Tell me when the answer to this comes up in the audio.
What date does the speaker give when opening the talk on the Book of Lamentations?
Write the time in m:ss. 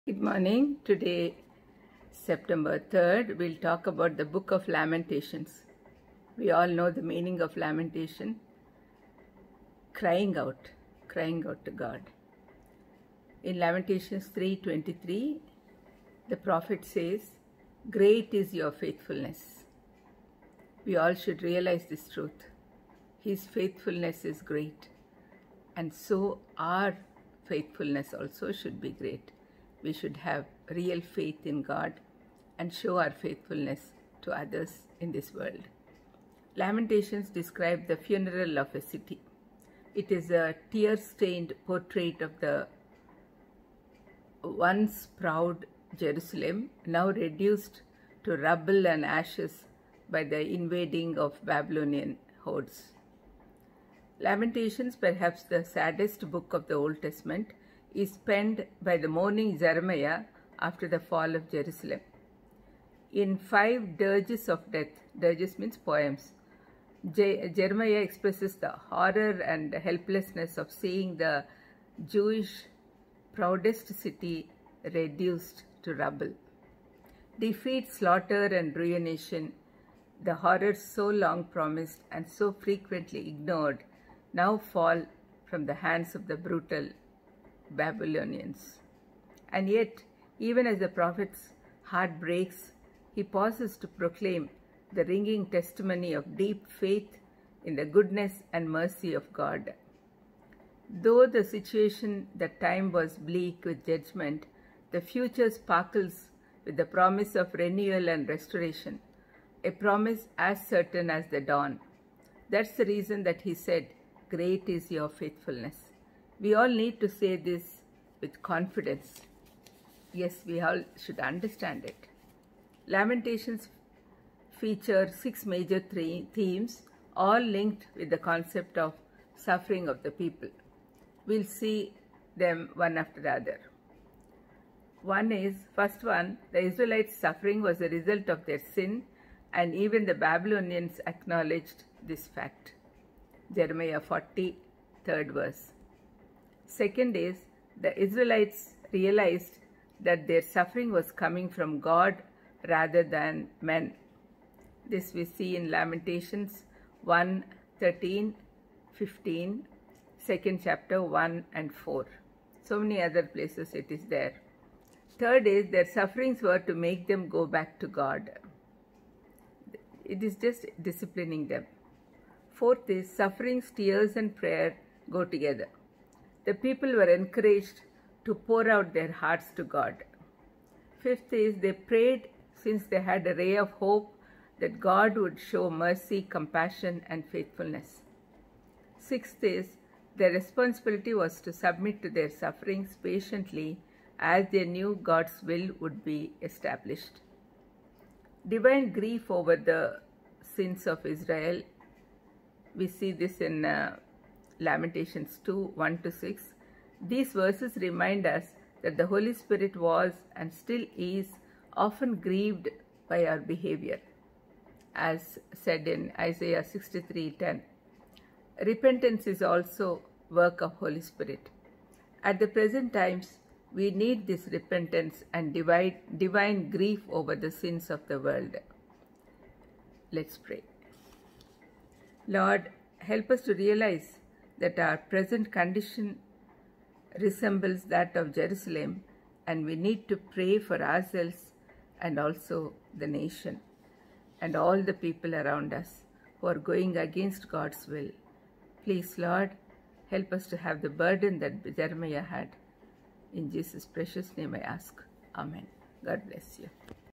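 0:02.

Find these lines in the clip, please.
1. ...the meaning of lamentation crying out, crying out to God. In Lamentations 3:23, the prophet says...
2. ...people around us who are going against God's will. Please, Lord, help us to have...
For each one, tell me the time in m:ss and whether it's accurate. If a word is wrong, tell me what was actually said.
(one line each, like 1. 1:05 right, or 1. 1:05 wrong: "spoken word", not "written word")
1. 0:06 right
2. 4:05 right.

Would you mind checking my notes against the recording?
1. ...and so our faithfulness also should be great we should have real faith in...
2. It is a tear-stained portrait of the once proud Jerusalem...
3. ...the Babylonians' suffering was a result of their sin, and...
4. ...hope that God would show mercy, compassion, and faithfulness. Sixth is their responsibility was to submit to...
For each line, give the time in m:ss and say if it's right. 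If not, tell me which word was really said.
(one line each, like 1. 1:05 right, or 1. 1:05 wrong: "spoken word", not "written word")
1. 0:25 right
2. 0:39 right
3. 2:16 wrong: "Israelites", not "Babylonians"
4. 3:03 right.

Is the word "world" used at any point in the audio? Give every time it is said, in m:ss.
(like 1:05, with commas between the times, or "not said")
0:35, 3:48.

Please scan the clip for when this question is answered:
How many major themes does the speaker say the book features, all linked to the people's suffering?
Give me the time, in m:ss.
2:05.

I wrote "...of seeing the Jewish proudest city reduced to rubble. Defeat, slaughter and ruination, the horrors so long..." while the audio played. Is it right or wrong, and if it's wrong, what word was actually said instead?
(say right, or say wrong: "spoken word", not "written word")
right.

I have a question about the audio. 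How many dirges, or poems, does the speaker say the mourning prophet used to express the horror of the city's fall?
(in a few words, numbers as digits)
5.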